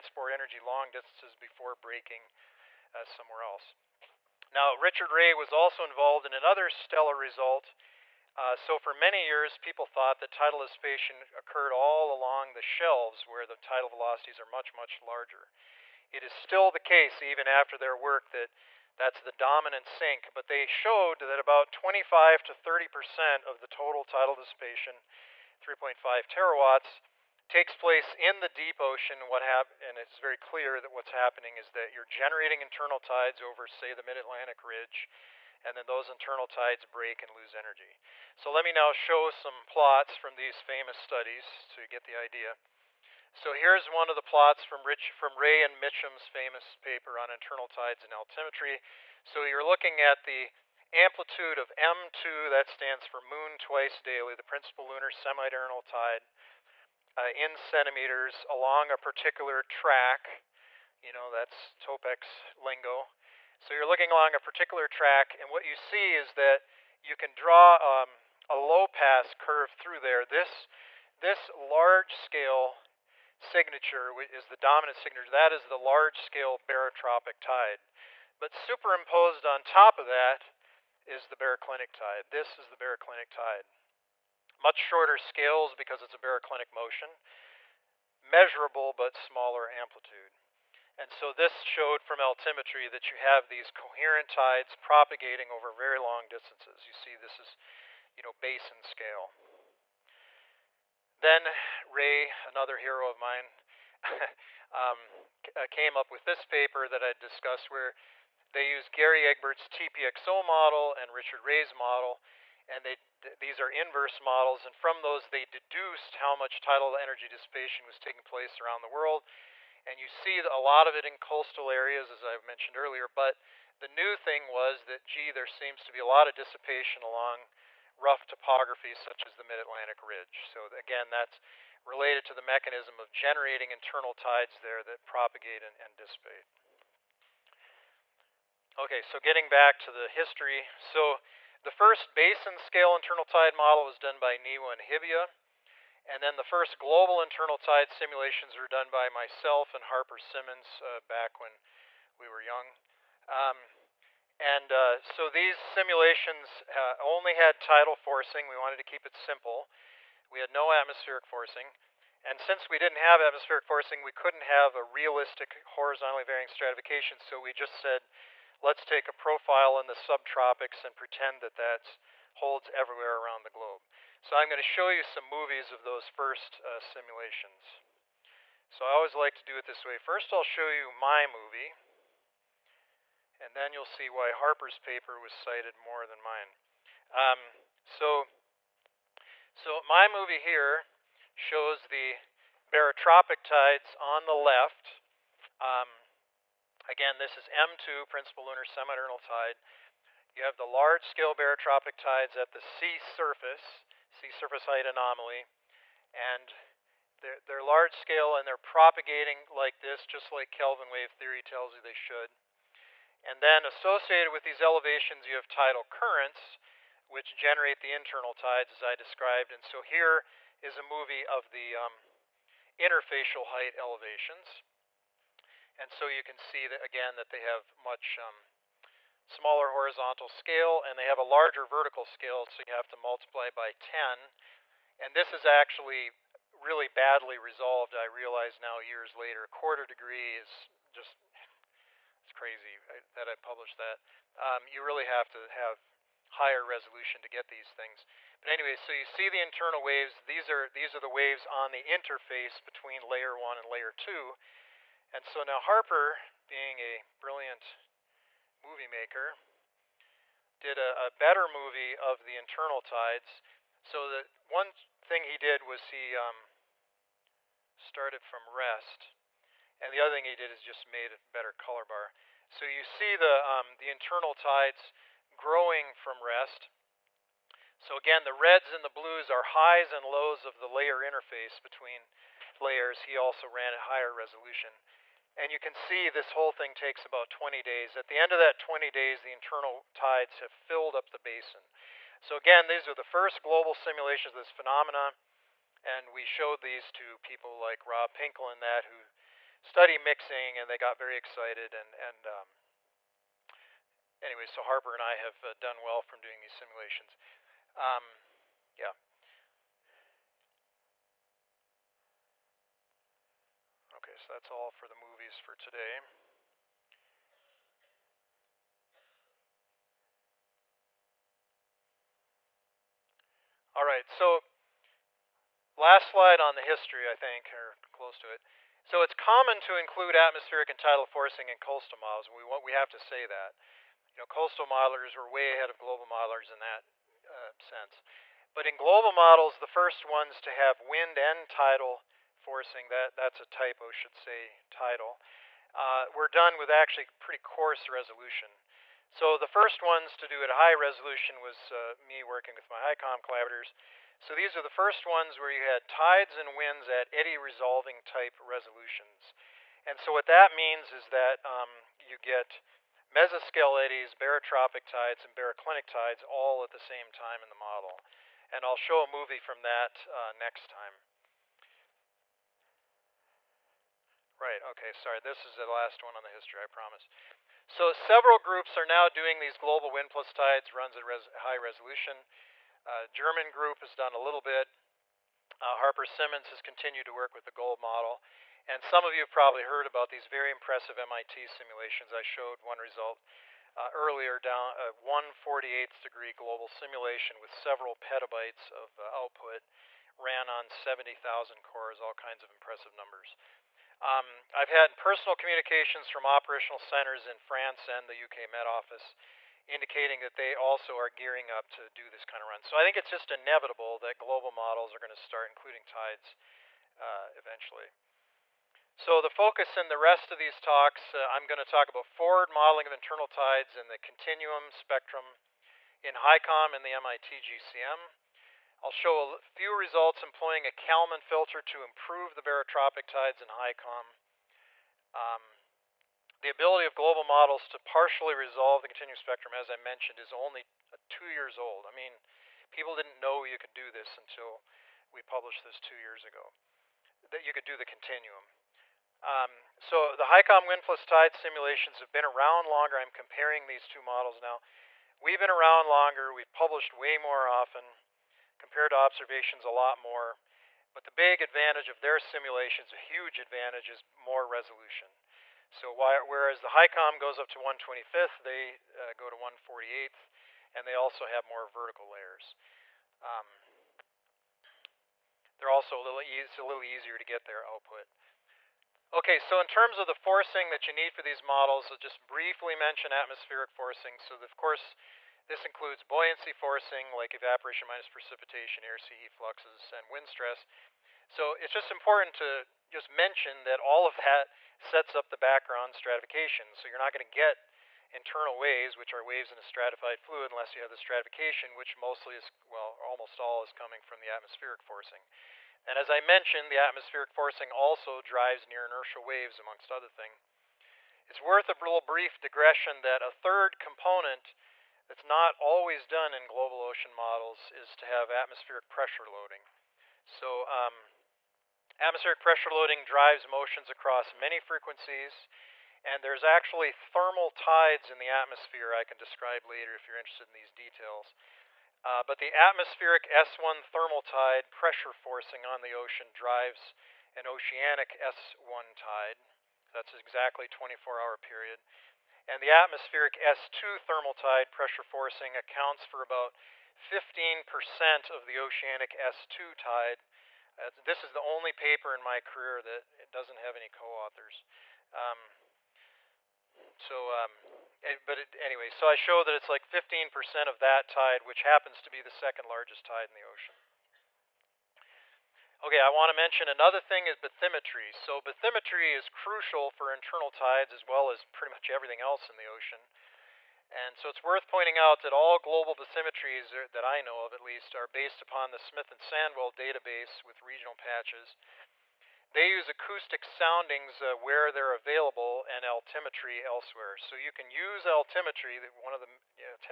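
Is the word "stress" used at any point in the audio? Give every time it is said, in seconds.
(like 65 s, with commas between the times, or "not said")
490 s.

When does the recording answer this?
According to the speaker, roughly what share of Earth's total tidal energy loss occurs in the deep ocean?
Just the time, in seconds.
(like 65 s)
21 s.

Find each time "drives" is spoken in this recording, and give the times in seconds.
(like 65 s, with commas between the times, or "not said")
508 s, 523 s, 536 s.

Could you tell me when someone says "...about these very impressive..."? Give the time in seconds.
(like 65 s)
389 s.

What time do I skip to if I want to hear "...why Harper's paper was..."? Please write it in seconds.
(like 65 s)
184 s.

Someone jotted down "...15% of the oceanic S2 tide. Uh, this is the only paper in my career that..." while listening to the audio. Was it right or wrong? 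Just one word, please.
right.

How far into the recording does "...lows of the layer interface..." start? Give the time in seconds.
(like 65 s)
280 s.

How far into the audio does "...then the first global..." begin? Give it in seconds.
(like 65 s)
146 s.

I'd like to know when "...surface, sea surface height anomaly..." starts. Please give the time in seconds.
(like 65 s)
202 s.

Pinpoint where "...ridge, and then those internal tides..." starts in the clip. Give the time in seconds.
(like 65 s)
34 s.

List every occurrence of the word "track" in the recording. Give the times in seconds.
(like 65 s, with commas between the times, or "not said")
59 s, 64 s.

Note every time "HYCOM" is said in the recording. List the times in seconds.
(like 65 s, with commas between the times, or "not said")
352 s, 426 s, 433 s, 450 s, 466 s.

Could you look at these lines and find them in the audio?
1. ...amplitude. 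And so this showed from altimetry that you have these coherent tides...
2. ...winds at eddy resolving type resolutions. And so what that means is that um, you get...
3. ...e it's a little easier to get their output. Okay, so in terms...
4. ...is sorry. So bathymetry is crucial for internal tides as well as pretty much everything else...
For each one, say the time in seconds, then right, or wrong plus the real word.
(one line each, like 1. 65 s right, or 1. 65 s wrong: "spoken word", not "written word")
1. 89 s right
2. 356 s right
3. 476 s right
4. 567 s wrong: "bathymetry", not "sorry".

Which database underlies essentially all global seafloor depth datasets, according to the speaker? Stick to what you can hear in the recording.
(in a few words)
Smith and Sandwell.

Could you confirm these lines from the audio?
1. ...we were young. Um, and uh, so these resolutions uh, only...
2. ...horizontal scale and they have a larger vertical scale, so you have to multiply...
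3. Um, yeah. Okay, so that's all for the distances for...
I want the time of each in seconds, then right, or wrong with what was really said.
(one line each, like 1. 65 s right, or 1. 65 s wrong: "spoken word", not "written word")
1. 152 s wrong: "simulations", not "resolutions"
2. 229 s right
3. 307 s wrong: "movies", not "distances".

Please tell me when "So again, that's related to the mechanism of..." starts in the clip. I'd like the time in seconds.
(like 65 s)
130 s.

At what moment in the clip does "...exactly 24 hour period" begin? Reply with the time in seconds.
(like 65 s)
540 s.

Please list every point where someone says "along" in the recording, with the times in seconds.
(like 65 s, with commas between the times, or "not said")
12 s, 58 s, 64 s, 127 s.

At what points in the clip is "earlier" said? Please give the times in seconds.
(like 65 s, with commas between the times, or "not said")
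122 s, 393 s.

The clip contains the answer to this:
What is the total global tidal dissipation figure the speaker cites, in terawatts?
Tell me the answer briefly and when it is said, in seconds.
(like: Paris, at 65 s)
3.5 terawatts, at 25 s.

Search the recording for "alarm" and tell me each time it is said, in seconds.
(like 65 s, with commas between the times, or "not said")
not said.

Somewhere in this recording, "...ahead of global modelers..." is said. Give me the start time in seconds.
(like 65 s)
335 s.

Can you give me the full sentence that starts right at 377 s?
So several groups are now doing these global wind plus tides runs at res high resolution.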